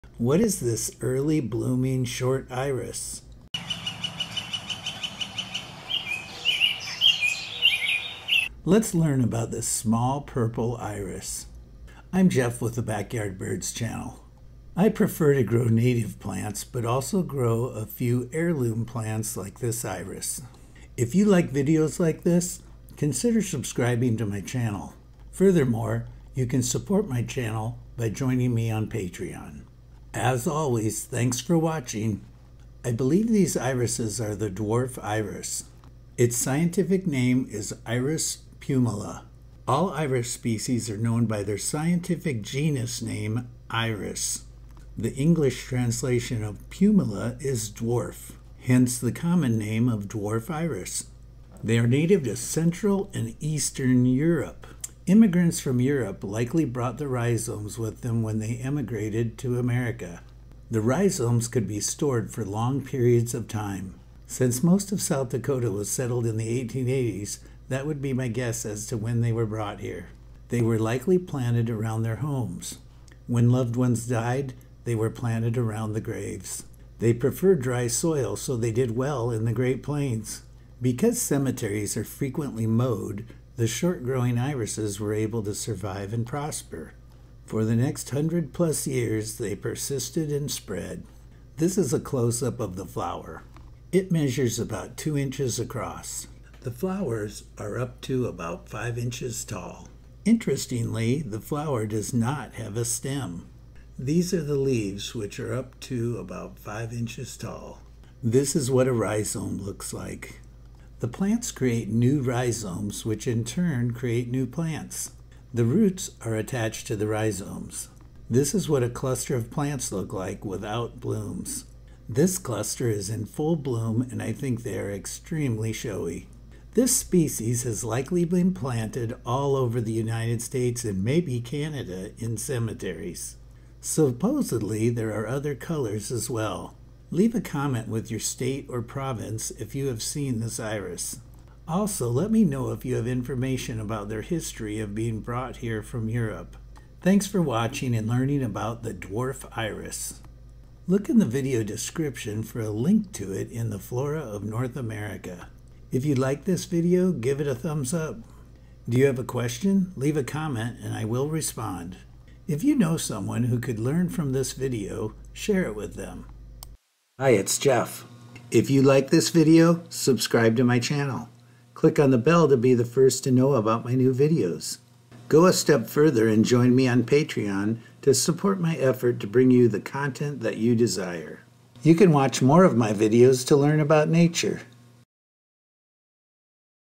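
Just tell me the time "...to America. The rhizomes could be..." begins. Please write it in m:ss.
0:59.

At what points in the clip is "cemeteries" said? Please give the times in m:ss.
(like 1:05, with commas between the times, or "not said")
1:21, 2:12.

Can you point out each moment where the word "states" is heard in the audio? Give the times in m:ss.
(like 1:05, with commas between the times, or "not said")
2:10, 2:18.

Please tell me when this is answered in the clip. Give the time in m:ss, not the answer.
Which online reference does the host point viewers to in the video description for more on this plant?
2:33.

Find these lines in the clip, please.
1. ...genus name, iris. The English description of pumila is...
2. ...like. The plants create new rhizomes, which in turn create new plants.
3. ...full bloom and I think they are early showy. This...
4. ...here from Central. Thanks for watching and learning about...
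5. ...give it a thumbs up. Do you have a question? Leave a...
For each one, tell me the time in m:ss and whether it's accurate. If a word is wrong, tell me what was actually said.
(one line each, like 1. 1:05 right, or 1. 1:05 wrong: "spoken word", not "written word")
1. 0:42 wrong: "translation", not "description"
2. 1:49 right
3. 2:03 wrong: "extremely", not "early"
4. 2:25 wrong: "Europe", not "Central"
5. 2:37 right.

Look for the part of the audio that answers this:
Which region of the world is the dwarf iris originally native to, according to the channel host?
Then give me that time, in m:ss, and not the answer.
0:52.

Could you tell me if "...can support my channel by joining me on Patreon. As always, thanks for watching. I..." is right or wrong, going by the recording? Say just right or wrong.
right.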